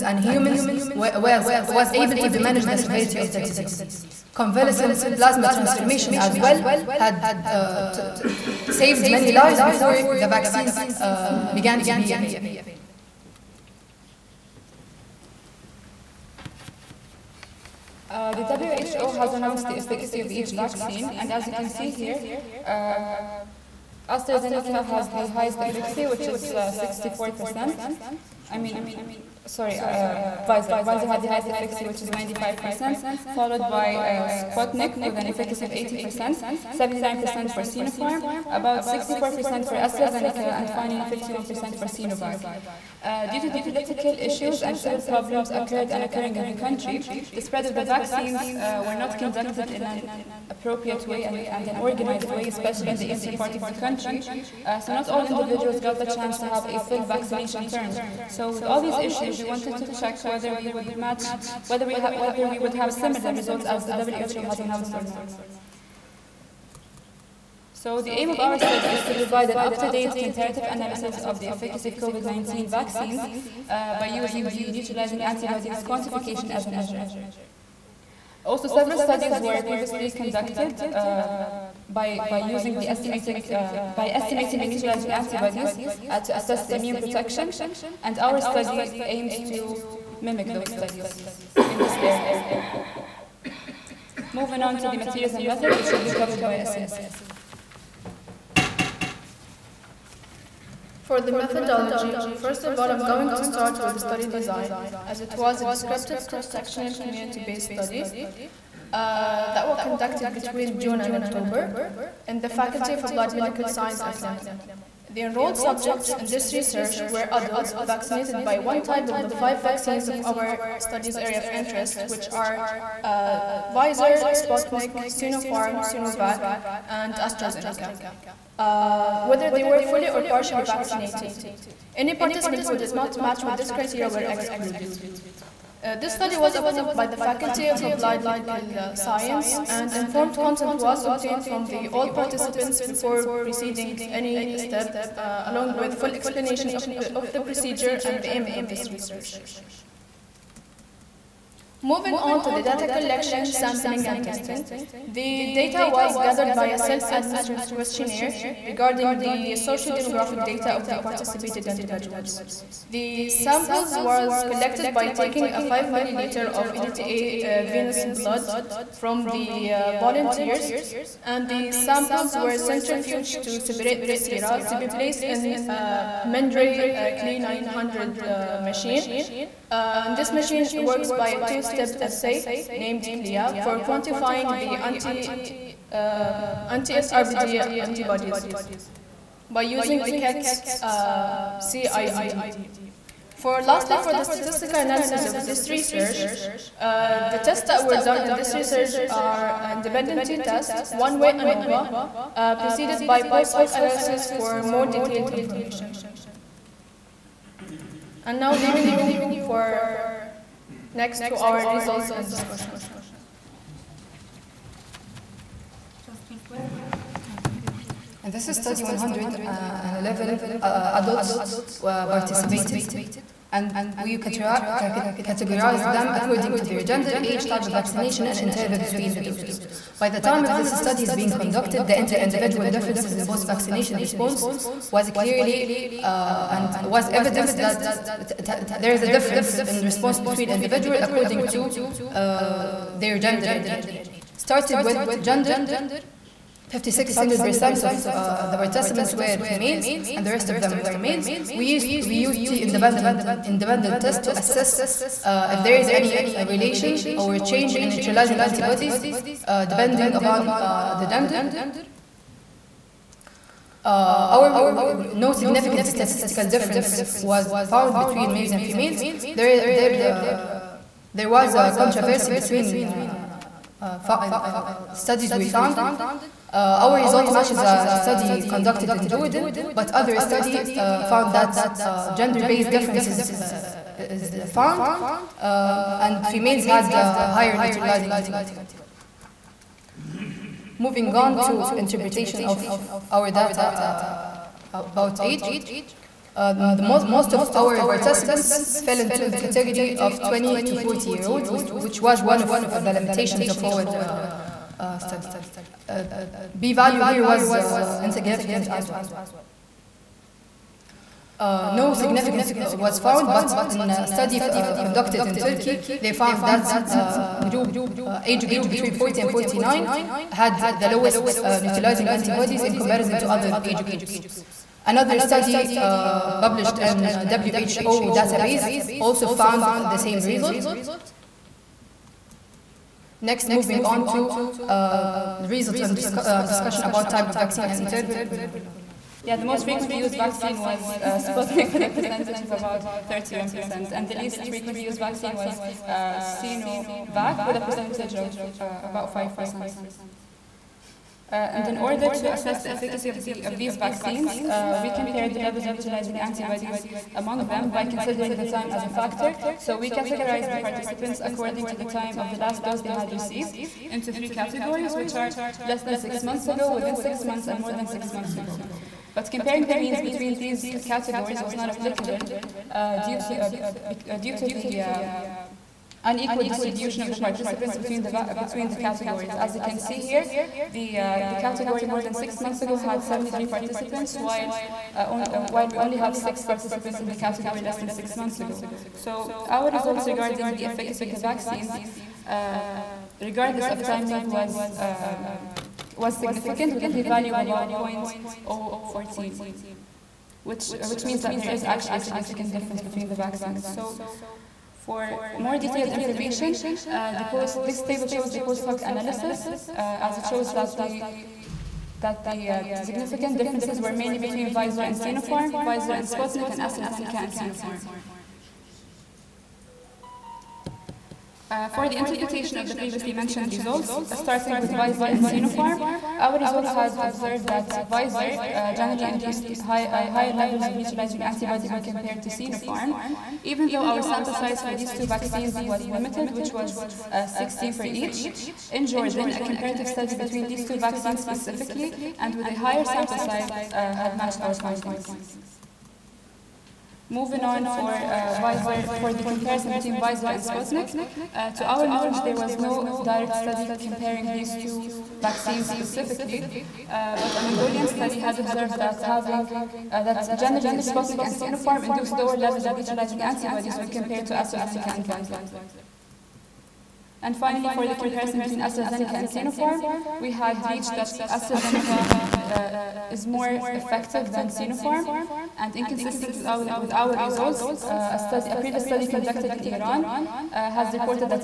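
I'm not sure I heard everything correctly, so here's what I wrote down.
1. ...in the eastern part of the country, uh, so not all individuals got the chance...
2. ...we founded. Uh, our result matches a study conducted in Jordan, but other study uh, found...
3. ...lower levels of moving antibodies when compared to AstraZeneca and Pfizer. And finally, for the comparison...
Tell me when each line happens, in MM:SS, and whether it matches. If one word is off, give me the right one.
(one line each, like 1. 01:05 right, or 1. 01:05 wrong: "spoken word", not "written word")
1. 00:52 right
2. 04:35 right
3. 07:42 wrong: "neutralizing", not "moving".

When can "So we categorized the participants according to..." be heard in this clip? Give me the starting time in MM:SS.
05:59.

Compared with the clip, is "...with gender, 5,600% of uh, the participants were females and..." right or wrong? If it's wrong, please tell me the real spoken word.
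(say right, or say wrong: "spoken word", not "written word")
right.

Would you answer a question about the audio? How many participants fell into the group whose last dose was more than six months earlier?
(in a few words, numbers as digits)
73.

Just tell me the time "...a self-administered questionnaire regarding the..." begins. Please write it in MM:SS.
02:36.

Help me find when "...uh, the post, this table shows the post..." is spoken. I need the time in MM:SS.
06:46.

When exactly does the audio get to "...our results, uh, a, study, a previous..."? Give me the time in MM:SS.
07:56.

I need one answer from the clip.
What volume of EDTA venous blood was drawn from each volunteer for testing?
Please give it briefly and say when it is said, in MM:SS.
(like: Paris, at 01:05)
5 milliliters, at 02:45.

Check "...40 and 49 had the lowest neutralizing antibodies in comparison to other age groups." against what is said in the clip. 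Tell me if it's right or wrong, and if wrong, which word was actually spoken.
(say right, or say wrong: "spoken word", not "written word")
right.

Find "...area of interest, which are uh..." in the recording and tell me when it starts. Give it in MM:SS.
02:01.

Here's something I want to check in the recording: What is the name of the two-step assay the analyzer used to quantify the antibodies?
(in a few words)
CLIA.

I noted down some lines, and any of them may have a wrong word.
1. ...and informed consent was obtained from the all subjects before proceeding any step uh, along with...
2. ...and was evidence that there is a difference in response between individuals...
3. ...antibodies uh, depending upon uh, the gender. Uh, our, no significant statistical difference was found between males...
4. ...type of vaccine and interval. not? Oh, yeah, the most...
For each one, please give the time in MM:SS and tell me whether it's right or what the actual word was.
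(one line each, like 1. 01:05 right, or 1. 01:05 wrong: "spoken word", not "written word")
1. 02:19 wrong: "participants", not "subjects"
2. 03:56 right
3. 04:18 right
4. 05:37 right.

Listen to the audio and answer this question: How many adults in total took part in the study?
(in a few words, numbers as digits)
111.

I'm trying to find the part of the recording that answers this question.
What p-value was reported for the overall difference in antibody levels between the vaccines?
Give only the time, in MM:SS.
06:37.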